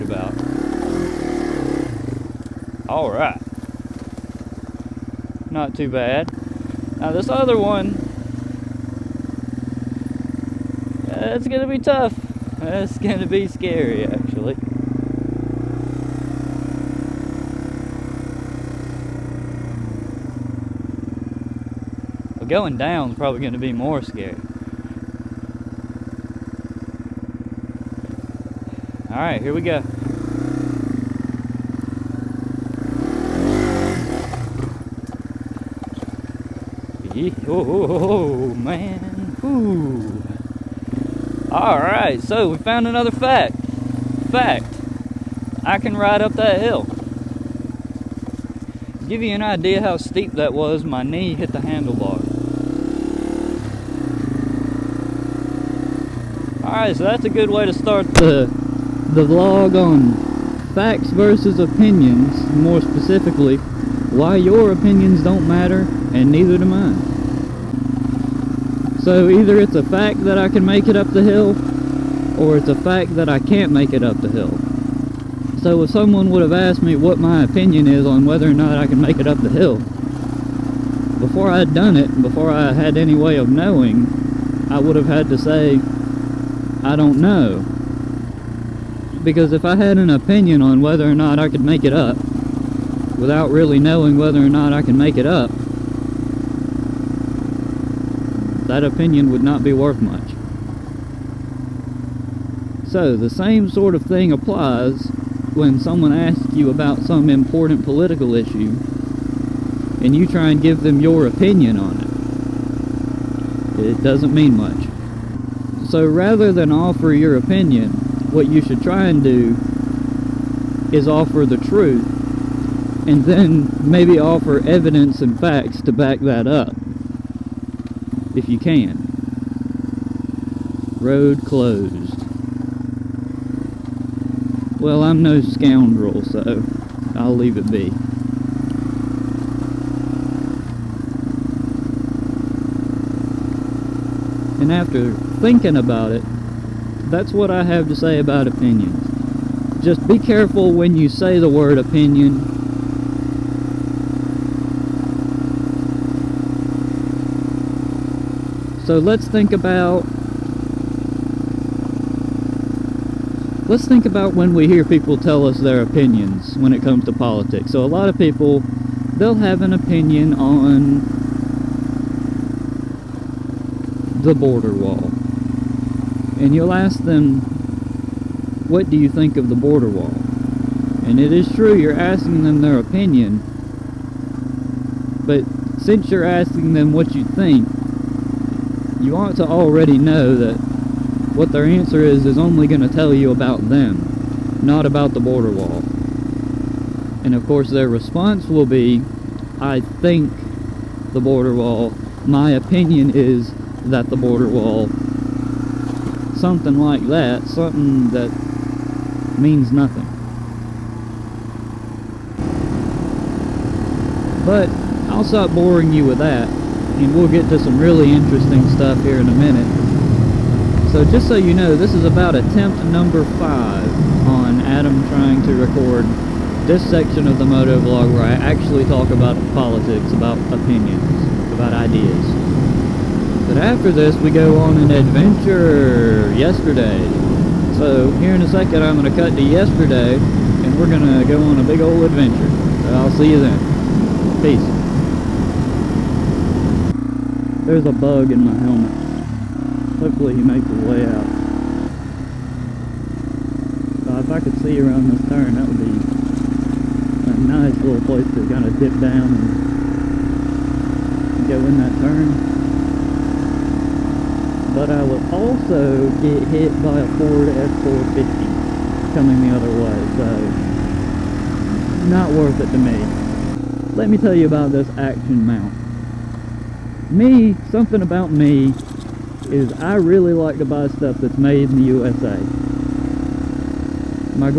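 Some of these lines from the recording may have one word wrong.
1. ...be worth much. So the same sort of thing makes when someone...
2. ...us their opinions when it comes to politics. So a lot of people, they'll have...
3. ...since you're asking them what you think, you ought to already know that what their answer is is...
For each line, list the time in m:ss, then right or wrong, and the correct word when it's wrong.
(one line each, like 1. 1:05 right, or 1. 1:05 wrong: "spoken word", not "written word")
1. 1:39 wrong: "applies", not "makes"
2. 2:45 right
3. 3:05 right.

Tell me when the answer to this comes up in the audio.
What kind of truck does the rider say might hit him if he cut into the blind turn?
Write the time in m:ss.
4:27.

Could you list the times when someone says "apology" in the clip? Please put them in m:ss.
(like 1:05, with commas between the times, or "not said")
not said.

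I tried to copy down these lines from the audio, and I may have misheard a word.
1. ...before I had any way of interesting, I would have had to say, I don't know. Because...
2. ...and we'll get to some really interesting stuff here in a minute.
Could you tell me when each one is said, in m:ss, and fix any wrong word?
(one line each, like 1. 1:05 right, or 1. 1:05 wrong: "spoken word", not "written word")
1. 1:22 wrong: "knowing", not "interesting"
2. 3:36 right.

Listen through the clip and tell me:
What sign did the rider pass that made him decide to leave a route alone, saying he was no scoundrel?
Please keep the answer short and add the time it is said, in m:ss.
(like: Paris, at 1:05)
Road closed, at 2:10.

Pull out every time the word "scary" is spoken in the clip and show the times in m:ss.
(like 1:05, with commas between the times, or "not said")
0:13, 0:24.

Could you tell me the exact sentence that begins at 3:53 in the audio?
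But after this, we go on an adventure yesterday.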